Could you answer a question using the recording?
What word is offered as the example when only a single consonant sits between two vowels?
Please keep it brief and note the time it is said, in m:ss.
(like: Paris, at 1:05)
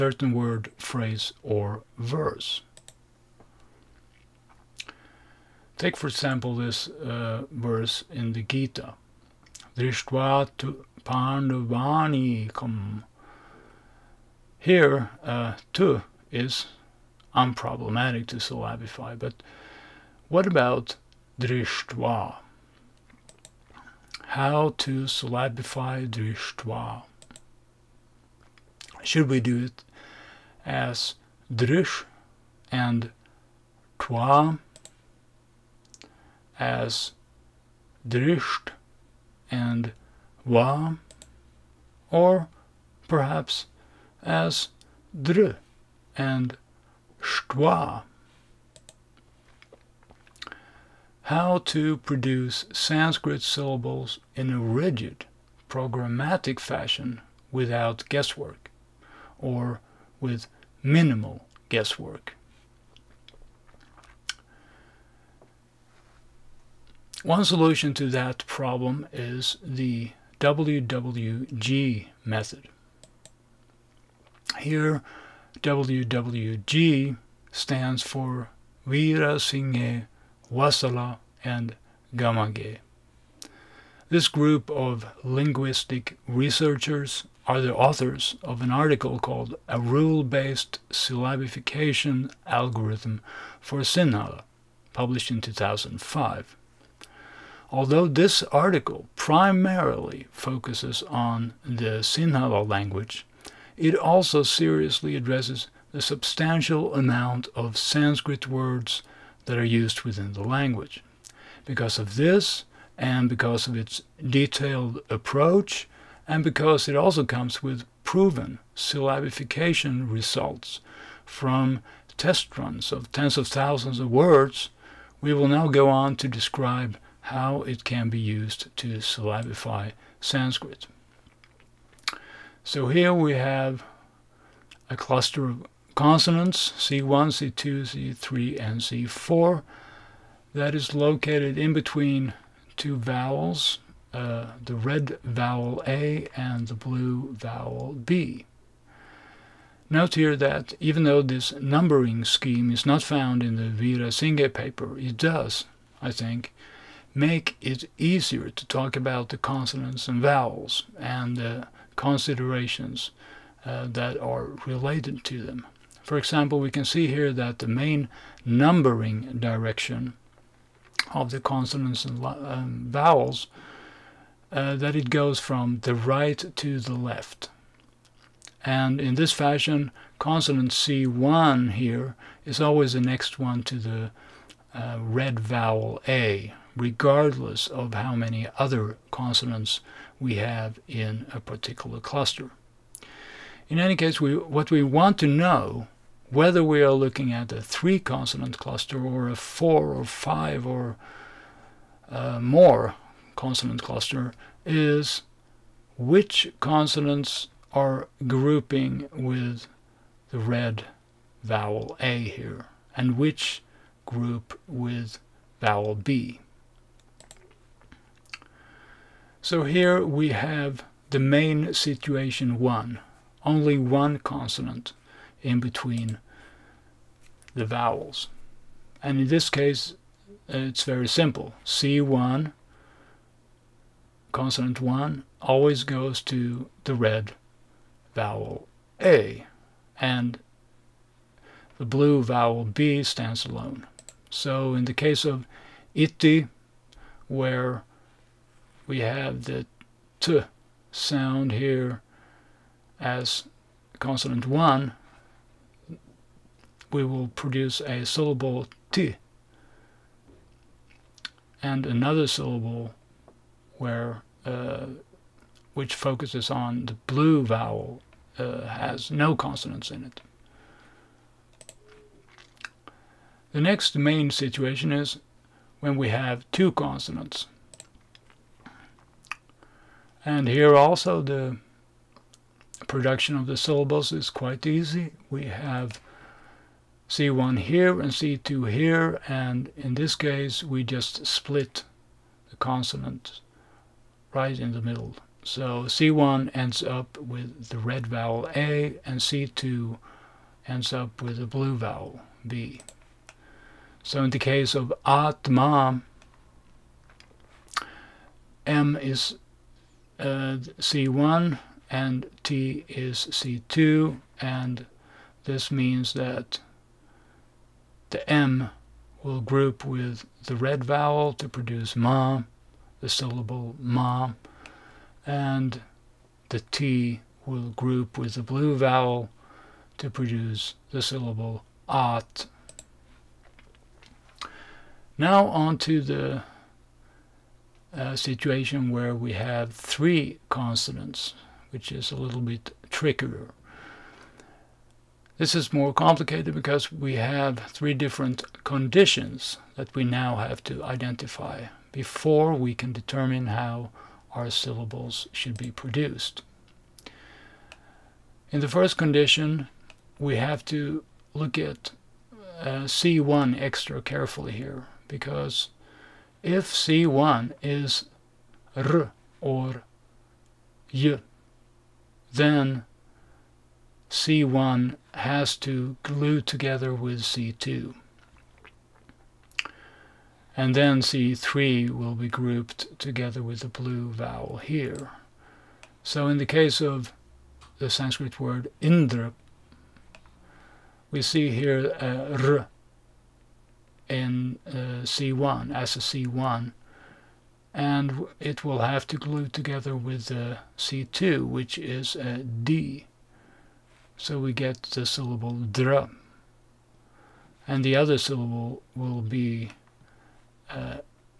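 iti, at 4:05.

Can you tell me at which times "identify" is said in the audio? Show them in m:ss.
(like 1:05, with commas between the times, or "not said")
5:50.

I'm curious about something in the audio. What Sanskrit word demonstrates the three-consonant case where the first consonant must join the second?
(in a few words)
Indra.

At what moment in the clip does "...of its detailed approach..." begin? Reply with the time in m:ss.
1:53.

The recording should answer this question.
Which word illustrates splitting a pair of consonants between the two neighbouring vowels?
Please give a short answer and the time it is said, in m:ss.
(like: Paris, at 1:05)
Atma, at 5:05.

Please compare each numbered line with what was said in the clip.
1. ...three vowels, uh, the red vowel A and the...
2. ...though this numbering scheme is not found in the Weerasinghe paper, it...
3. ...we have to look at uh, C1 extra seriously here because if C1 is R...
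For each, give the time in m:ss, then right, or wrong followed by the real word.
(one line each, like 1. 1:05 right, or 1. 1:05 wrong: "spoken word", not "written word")
1. 2:22 wrong: "two", not "three"
2. 2:31 right
3. 6:00 wrong: "carefully", not "seriously".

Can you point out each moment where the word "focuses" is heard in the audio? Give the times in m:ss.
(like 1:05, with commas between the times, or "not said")
1:40, 4:25.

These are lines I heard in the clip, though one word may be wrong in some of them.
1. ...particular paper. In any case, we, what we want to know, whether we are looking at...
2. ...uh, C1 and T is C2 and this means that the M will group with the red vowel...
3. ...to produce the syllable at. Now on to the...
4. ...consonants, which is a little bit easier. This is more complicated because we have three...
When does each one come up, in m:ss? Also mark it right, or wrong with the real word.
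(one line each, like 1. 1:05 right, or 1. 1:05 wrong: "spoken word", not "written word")
1. 3:11 wrong: "cluster", not "paper"
2. 5:10 right
3. 5:29 right
4. 5:40 wrong: "trickier", not "easier".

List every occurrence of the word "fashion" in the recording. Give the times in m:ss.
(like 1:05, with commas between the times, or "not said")
0:56, 2:59.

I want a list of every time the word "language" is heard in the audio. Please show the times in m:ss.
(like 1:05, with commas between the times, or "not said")
1:42, 1:50.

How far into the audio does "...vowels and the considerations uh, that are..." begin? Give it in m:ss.
2:40.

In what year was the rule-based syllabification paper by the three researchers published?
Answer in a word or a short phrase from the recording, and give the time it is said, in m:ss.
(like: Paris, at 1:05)
2005, at 1:35.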